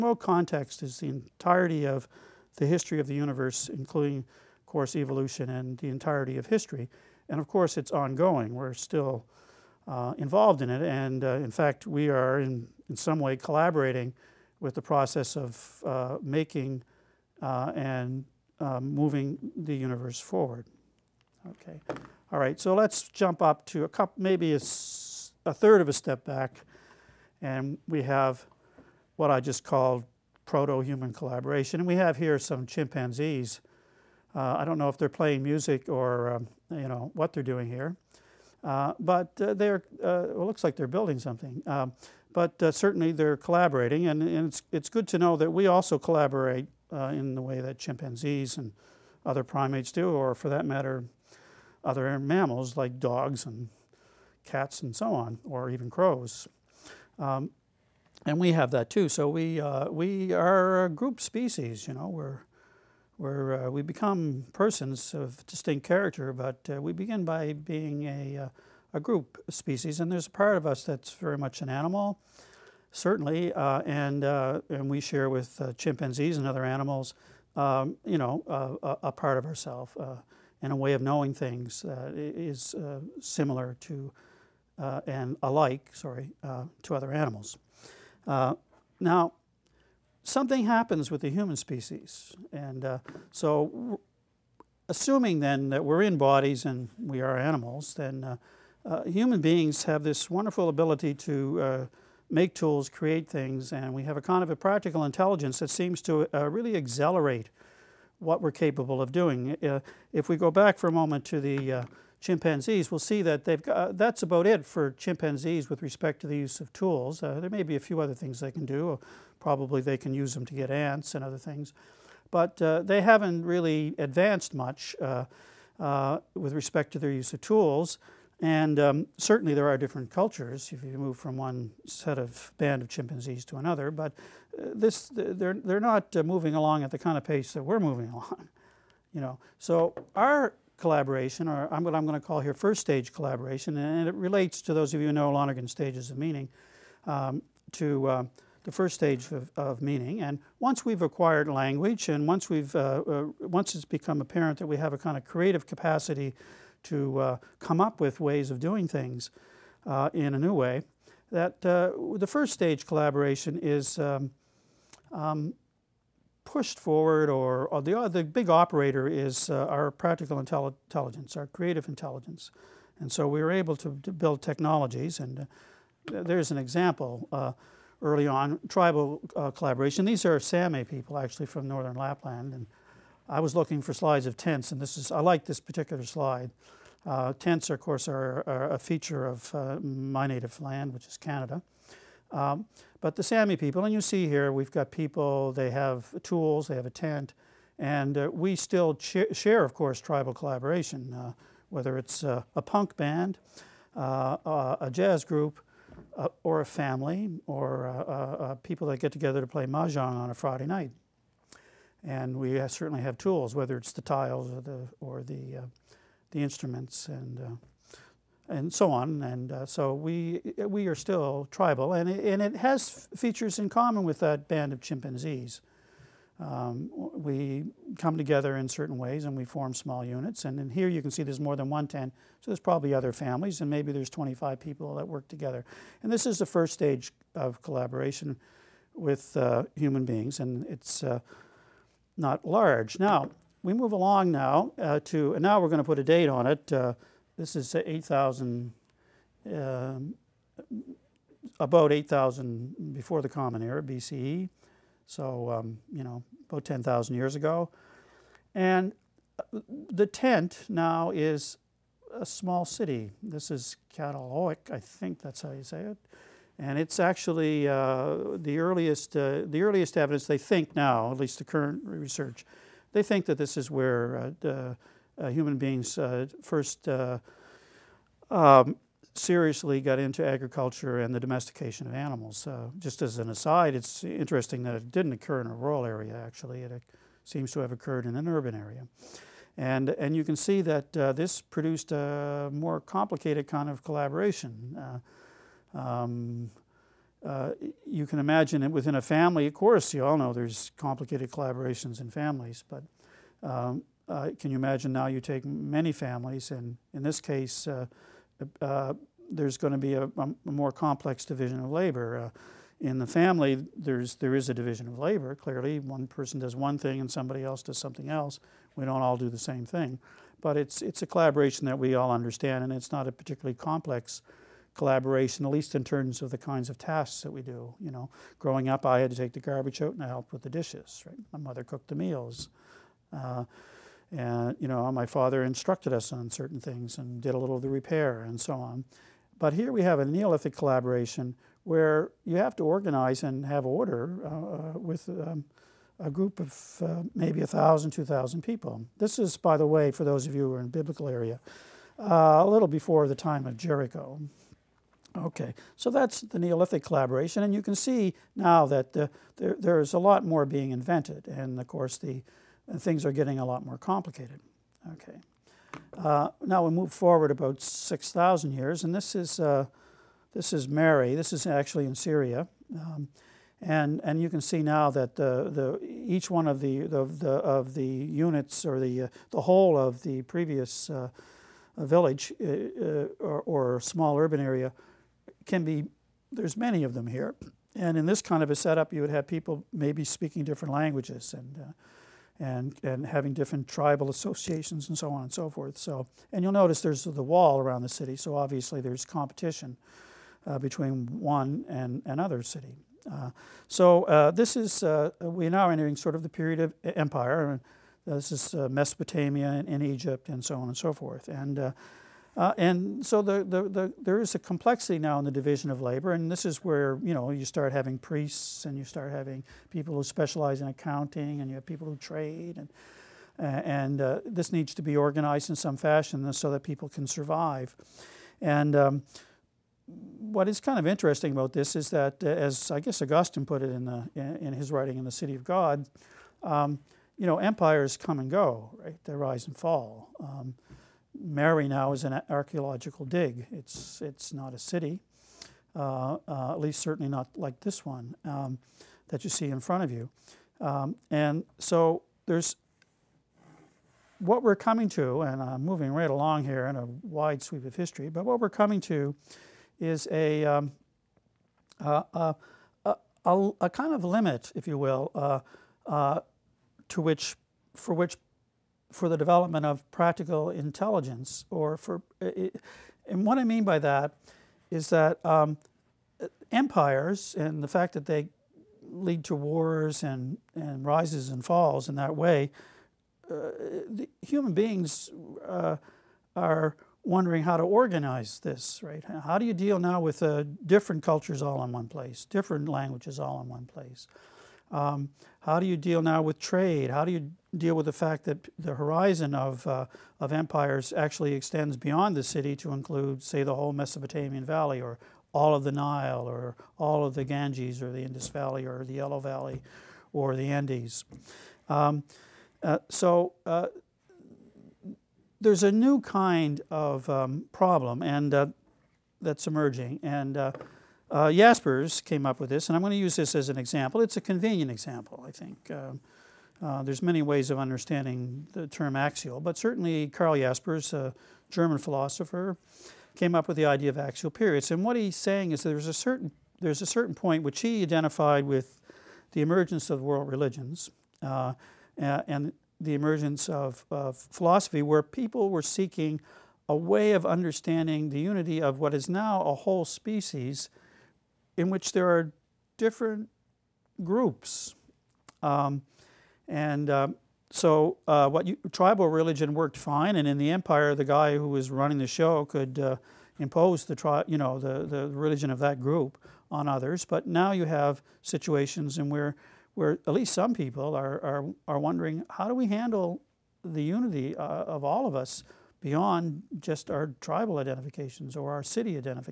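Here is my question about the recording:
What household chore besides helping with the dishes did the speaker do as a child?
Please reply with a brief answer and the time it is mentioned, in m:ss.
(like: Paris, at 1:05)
take the garbage out, at 5:29.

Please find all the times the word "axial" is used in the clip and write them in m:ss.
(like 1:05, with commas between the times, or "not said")
8:48, 8:53.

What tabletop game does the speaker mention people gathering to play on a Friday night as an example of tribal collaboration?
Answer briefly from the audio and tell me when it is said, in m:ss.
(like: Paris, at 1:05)
mahjong, at 3:29.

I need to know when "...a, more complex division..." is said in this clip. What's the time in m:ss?
5:10.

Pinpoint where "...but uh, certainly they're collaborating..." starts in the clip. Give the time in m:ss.
0:42.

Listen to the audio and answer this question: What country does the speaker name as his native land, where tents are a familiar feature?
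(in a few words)
Canada.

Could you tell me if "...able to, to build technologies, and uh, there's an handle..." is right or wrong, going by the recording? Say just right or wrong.
wrong.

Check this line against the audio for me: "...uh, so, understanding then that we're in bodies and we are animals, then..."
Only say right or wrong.
wrong.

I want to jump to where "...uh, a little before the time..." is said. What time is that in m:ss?
5:51.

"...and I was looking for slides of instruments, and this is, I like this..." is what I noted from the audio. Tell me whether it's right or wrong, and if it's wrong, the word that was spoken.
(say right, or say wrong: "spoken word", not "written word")
wrong: "tents", not "instruments".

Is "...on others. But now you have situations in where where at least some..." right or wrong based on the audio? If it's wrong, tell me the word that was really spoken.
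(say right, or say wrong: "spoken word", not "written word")
right.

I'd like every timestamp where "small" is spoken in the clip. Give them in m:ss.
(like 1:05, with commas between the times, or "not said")
3:49, 4:22, 6:23.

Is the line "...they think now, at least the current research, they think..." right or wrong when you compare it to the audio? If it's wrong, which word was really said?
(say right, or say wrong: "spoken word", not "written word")
right.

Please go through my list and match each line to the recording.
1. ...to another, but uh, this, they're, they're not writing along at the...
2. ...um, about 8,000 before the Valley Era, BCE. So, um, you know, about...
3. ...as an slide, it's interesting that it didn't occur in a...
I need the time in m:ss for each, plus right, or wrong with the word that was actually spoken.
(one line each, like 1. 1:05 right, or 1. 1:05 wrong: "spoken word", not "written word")
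1. 2:13 wrong: "moving", not "writing"
2. 4:09 wrong: "Common", not "Valley"
3. 4:43 wrong: "aside", not "slide".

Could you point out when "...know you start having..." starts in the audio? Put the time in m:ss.
6:57.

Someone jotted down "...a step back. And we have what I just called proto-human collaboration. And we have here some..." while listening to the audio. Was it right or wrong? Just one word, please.
right.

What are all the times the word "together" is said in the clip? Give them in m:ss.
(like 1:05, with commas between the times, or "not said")
3:29, 3:48, 3:55.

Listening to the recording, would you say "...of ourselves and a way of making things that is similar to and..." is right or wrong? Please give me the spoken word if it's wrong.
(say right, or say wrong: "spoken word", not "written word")
wrong: "knowing", not "making".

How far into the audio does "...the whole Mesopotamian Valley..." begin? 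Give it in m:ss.
8:23.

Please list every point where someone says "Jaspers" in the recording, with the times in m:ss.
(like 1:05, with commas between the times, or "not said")
8:41, 8:50.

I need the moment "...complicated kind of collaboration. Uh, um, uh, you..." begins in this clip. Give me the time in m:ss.
4:52.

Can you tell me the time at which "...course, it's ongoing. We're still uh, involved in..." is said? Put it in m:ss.
0:07.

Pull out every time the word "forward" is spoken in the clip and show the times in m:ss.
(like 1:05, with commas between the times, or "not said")
0:20, 2:46, 6:06.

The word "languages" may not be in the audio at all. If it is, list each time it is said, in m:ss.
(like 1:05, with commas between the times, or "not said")
2:31, 6:30, 8:12.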